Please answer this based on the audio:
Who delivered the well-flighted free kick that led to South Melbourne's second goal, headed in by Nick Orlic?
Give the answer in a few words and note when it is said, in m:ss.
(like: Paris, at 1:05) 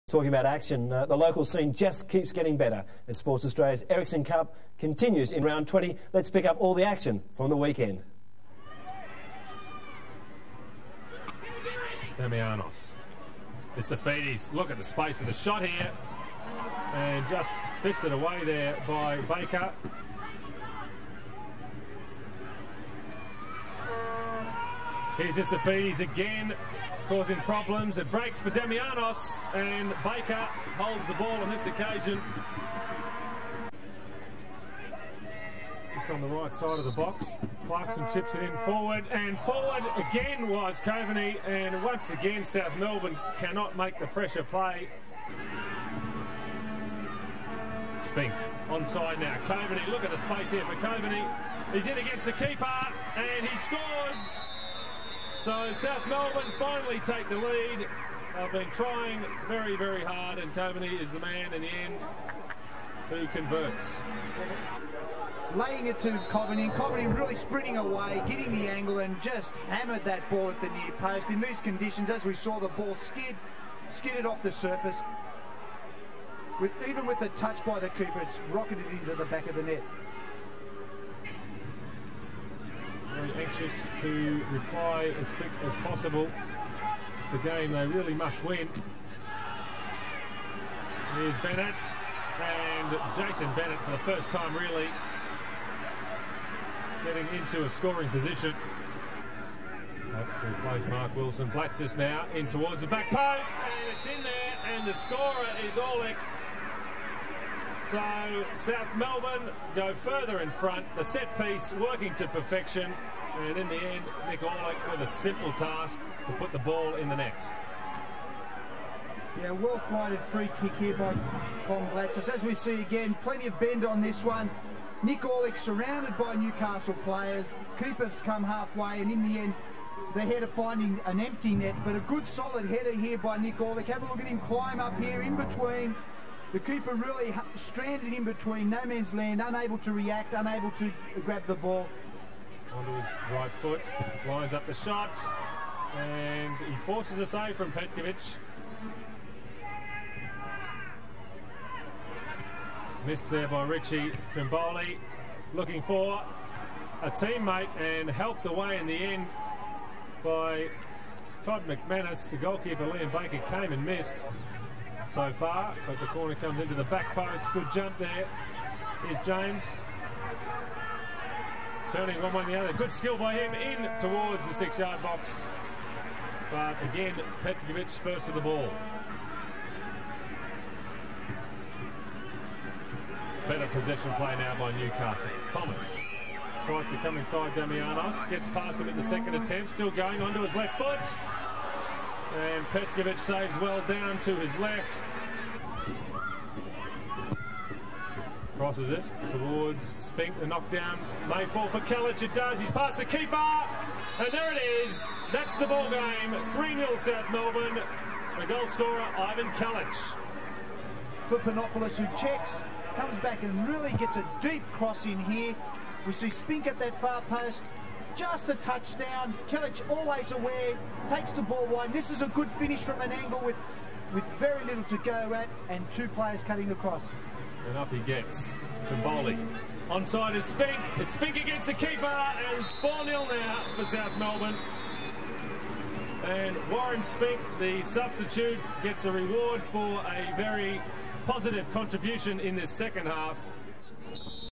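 Colin Blatsis, at 2:01.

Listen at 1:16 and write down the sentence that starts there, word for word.
With, even with a touch by the keeper, it's rocketed into the back of the net.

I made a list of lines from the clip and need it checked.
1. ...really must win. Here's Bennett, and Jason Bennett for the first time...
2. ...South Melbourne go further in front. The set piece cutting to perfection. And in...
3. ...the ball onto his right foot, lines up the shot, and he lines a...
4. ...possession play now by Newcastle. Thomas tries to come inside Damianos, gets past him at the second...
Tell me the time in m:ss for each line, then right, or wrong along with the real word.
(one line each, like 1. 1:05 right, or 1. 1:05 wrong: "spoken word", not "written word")
1. 1:27 right
2. 1:48 wrong: "working", not "cutting"
3. 2:21 wrong: "forces", not "lines"
4. 3:03 right.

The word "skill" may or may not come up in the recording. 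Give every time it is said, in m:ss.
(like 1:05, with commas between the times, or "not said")
2:52.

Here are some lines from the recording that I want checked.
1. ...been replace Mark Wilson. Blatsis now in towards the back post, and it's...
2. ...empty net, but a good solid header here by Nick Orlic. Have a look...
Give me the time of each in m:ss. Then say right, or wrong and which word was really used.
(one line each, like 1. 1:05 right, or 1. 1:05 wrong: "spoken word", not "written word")
1. 1:40 right
2. 2:11 right.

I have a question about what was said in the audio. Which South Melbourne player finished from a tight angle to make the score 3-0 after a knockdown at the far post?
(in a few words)
Ivan Kelic.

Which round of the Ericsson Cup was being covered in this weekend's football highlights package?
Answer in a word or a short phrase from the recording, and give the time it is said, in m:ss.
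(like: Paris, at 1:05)
20, at 0:05.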